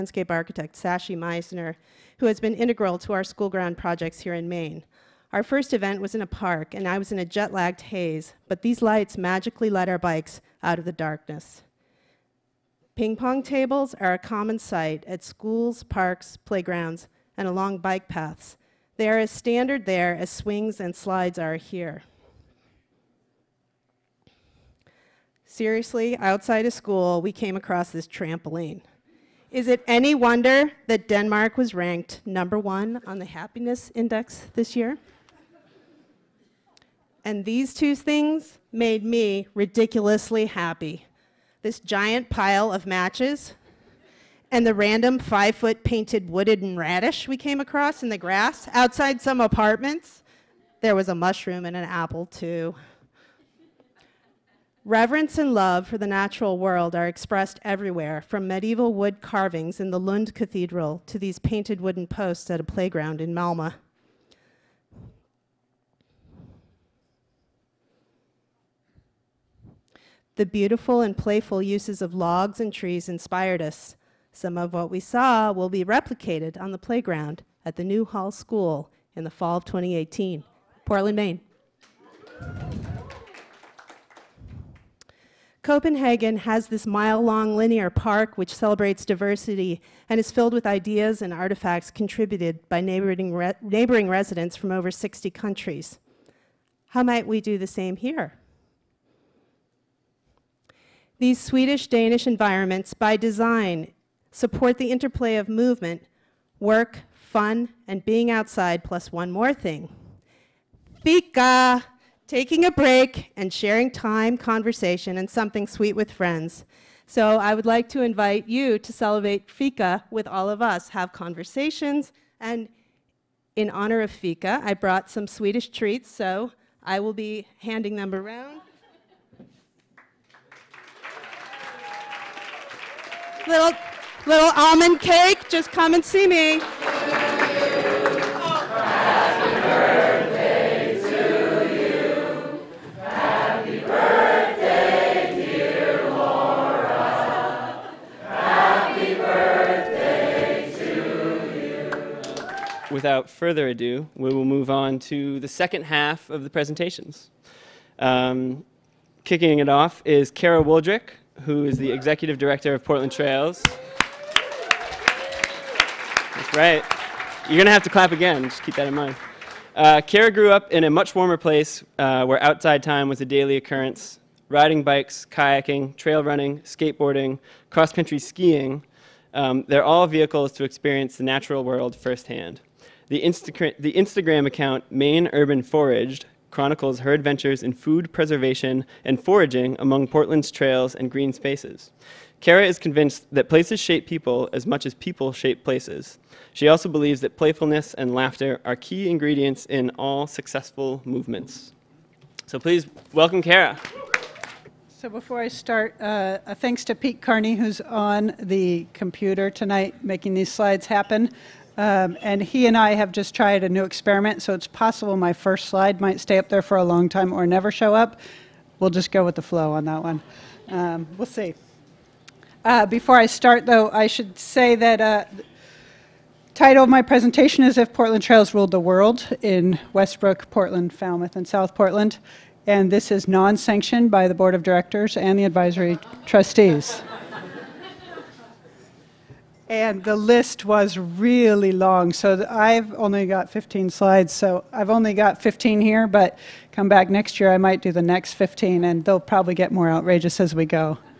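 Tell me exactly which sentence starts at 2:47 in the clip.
You're going to have to clap again, just keep that in mind.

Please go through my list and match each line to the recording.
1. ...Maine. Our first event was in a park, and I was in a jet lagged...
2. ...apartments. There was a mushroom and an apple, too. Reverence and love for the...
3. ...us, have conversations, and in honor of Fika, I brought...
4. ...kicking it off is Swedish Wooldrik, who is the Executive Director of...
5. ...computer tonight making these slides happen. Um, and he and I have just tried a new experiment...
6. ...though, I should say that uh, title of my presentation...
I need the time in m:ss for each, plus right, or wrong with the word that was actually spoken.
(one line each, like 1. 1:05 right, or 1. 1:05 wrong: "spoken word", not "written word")
1. 0:04 right
2. 0:49 right
3. 2:00 right
4. 2:39 wrong: "Kara", not "Swedish"
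5. 3:28 right
6. 3:43 right.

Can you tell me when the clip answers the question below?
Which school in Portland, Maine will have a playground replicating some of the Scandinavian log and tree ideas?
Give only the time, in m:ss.
1:17.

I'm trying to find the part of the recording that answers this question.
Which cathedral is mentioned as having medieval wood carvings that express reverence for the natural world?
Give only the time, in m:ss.
0:59.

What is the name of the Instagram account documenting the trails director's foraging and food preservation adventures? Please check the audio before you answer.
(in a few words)
Maine Urban Foraged.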